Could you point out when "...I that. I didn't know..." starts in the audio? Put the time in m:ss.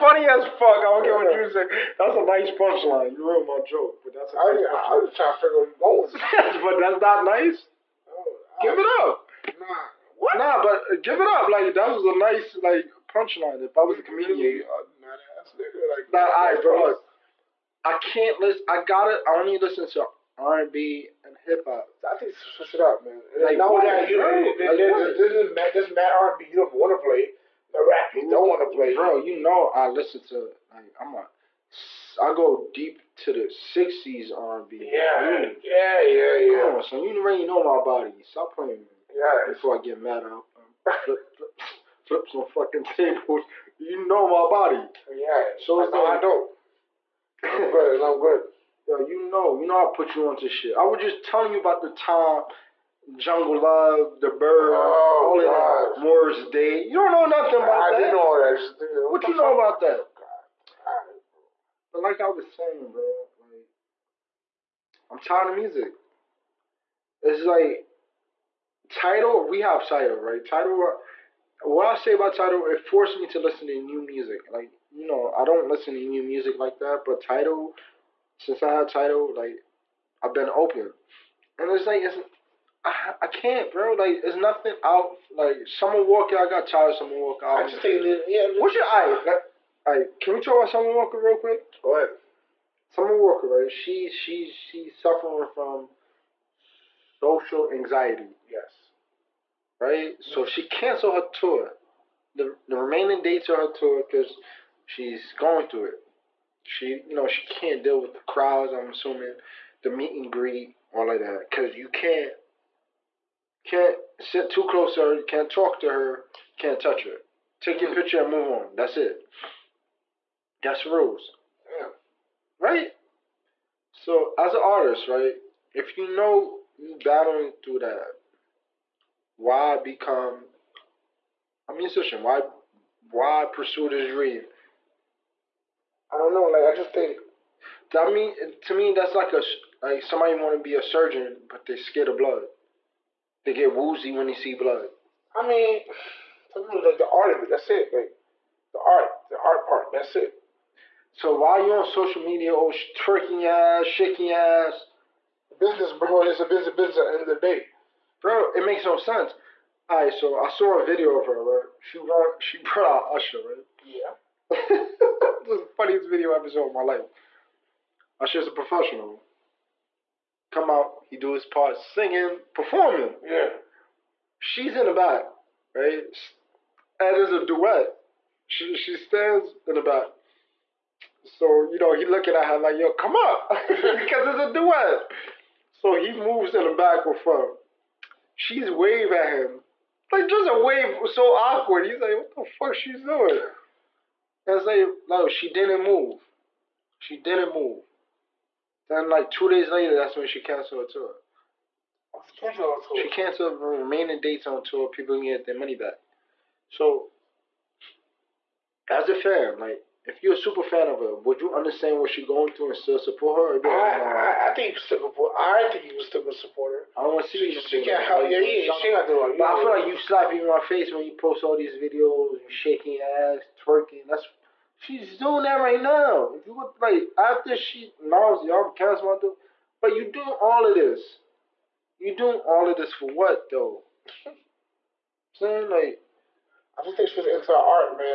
0:57.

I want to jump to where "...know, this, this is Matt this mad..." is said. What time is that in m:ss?
0:24.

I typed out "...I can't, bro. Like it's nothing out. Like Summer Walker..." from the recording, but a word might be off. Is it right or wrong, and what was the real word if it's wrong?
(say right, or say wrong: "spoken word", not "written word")
right.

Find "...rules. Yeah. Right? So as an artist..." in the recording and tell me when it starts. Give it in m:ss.
2:00.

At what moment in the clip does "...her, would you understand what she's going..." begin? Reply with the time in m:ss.
3:30.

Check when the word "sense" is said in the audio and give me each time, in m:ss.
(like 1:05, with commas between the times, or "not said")
2:38.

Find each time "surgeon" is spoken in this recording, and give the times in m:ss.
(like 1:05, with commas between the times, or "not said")
2:20.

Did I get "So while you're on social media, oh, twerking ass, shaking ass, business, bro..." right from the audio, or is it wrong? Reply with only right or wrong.
right.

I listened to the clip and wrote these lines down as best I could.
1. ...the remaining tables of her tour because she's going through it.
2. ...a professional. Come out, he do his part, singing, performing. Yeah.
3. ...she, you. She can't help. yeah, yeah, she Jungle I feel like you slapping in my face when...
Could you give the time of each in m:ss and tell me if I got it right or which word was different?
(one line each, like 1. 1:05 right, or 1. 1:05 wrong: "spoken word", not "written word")
1. 1:42 wrong: "dates", not "tables"
2. 2:48 right
3. 3:37 wrong: "But", not "Jungle".